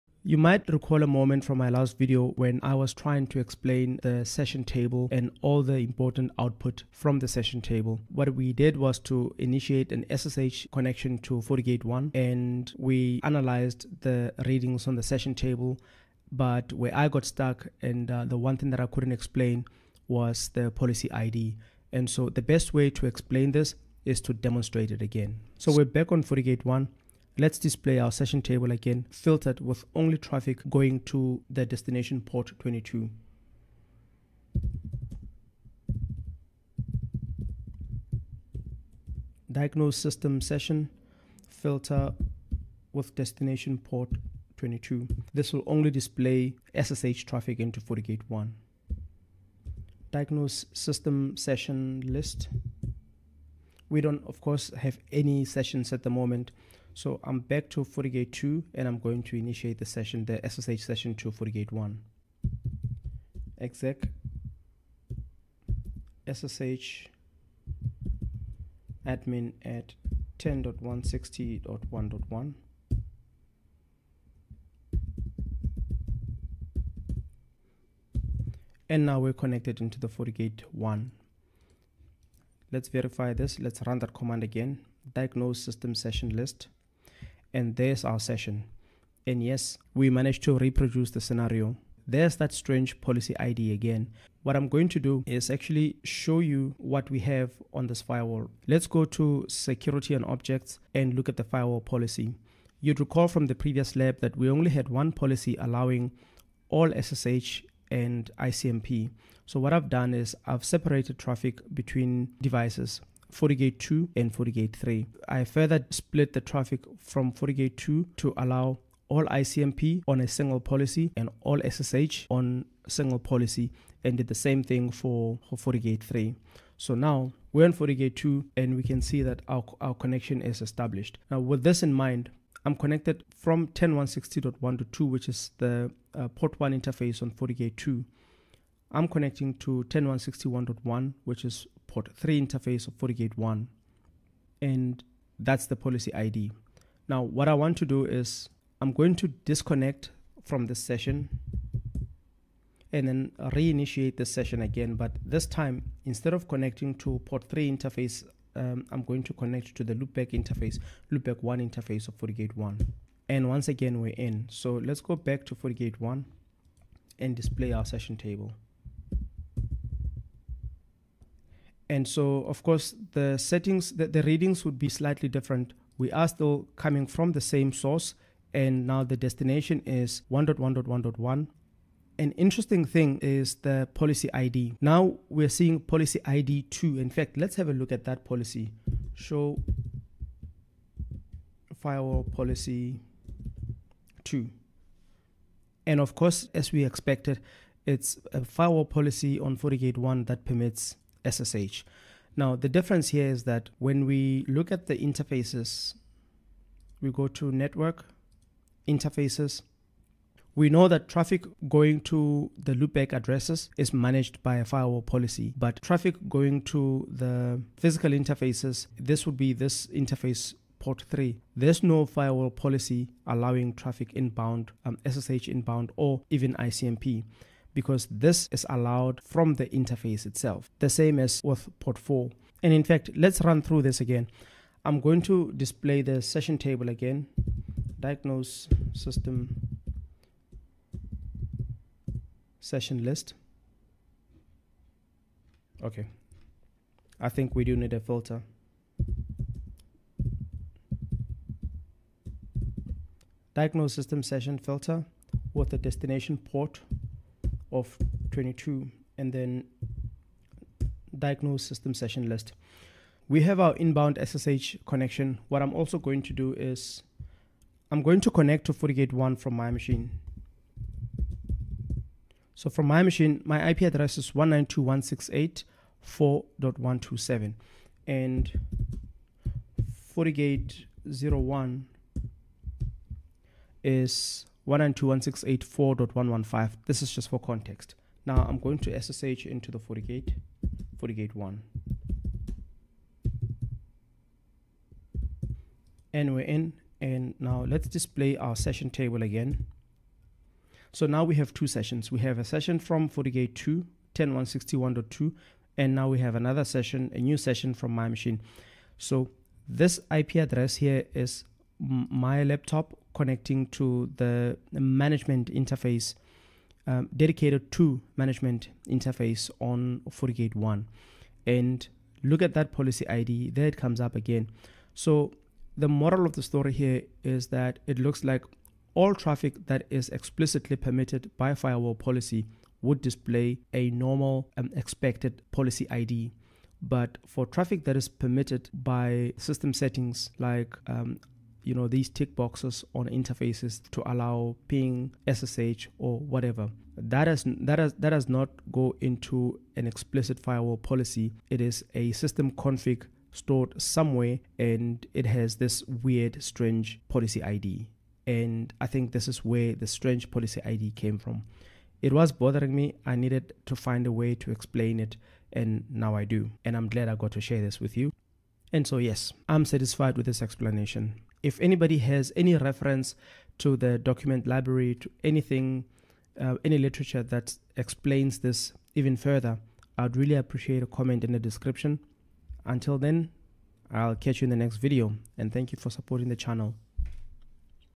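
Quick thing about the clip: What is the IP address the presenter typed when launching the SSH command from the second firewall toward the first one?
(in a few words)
10.160.1.1.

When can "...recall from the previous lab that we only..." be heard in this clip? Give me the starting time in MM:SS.
01:42.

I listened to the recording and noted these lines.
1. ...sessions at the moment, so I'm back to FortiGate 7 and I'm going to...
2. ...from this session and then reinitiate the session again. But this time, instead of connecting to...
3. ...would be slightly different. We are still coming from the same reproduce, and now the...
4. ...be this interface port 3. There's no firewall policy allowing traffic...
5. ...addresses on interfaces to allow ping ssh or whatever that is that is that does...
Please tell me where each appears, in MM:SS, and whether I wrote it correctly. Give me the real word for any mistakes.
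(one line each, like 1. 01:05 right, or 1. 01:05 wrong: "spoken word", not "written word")
1. 00:55 wrong: "2", not "7"
2. 02:30 right
3. 02:54 wrong: "source", not "reproduce"
4. 03:39 right
5. 05:42 wrong: "boxes", not "addresses".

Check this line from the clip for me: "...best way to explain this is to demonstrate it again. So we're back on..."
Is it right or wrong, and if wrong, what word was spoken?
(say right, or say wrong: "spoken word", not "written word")
right.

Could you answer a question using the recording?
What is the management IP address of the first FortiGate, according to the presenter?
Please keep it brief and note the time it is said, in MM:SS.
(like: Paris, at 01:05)
192.168.4.115, at 04:44.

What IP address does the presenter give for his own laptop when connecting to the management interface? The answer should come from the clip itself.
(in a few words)
192.168.4.127.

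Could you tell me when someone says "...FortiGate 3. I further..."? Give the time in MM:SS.
01:54.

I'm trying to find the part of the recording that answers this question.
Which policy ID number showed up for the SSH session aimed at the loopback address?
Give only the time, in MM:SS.
03:05.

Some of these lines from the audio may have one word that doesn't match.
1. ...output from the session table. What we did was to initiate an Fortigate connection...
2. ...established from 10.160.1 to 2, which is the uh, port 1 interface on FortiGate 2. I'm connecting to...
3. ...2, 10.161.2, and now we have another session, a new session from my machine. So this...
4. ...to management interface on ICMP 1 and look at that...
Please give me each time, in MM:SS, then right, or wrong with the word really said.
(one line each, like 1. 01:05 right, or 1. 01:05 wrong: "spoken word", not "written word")
1. 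00:06 wrong: "SSH", not "Fortigate"
2. 02:12 wrong: "connected", not "established"
3. 05:03 right
4. 05:17 wrong: "FortiGate", not "ICMP".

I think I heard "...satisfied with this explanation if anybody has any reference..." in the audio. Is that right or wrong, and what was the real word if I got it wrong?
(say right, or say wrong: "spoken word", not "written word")
right.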